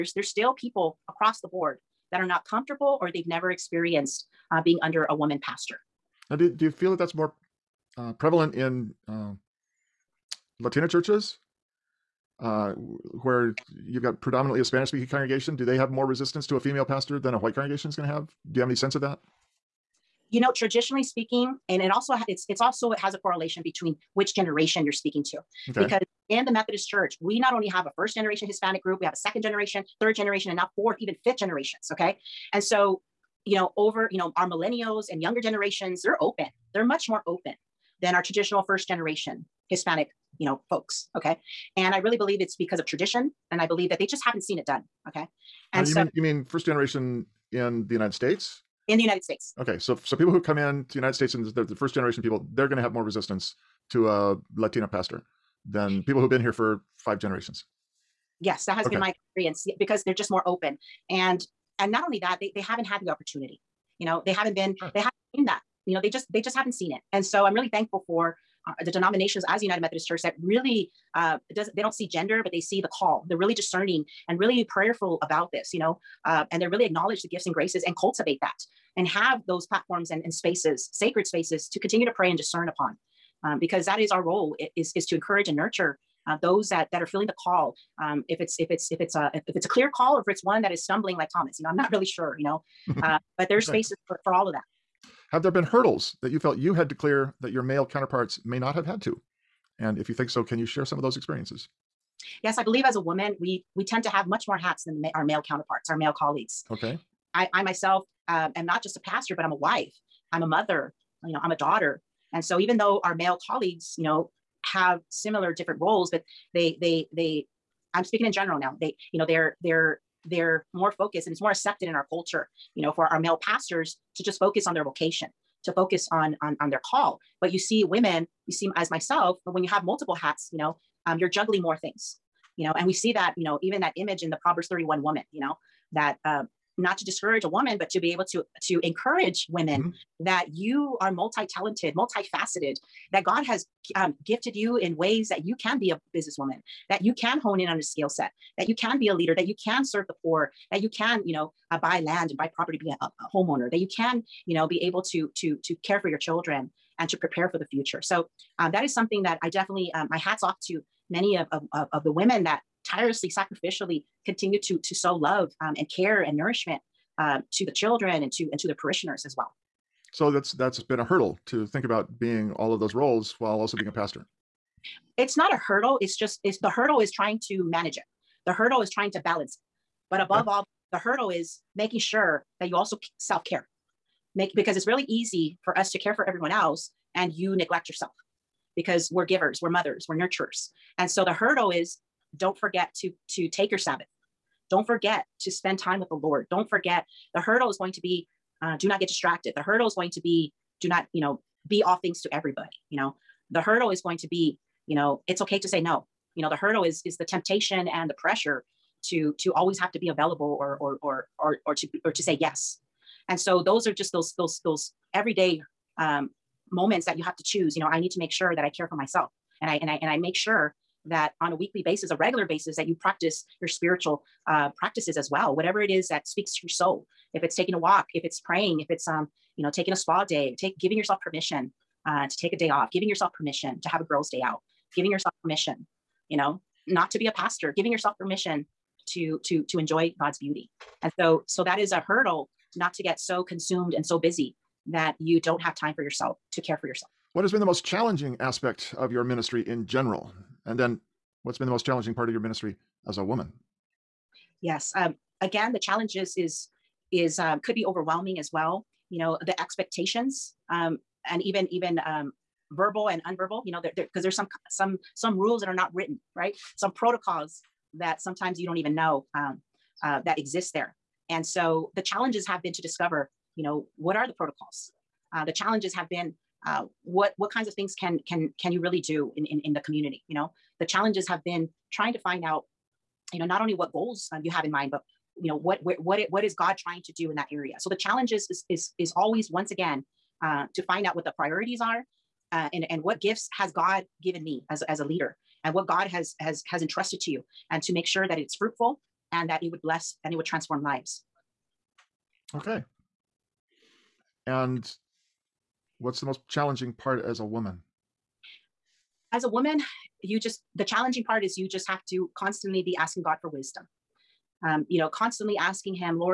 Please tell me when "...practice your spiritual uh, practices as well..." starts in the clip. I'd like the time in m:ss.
3:43.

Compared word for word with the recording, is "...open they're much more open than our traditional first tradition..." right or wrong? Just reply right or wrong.
wrong.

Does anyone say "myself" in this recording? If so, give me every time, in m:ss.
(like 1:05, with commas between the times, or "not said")
1:47, 2:08, 3:38.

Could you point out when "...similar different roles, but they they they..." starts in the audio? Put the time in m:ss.
1:55.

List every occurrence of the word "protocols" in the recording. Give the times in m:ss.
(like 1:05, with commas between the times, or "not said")
4:26, 4:34.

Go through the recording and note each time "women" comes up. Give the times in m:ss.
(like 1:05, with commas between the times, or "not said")
2:07, 2:19, 2:42.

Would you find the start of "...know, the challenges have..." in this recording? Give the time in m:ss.
4:40.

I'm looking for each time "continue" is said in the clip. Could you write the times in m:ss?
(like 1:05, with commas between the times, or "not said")
1:21, 2:44.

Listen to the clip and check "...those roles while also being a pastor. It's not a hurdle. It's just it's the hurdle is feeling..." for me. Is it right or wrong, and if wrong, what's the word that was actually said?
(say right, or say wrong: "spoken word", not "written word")
wrong: "trying", not "feeling".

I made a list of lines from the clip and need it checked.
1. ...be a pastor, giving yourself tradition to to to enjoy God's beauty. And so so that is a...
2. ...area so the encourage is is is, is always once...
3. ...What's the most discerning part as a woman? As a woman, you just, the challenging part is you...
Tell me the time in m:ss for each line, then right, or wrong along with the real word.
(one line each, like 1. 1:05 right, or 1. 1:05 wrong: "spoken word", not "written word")
1. 3:57 wrong: "permission", not "tradition"
2. 4:47 wrong: "challenge", not "encourage"
3. 5:05 wrong: "challenging", not "discerning".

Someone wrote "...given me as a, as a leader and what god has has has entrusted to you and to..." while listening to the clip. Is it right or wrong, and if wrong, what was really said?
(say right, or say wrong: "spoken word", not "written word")
right.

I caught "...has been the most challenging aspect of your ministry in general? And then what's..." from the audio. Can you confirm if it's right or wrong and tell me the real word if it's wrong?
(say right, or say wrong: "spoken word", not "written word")
right.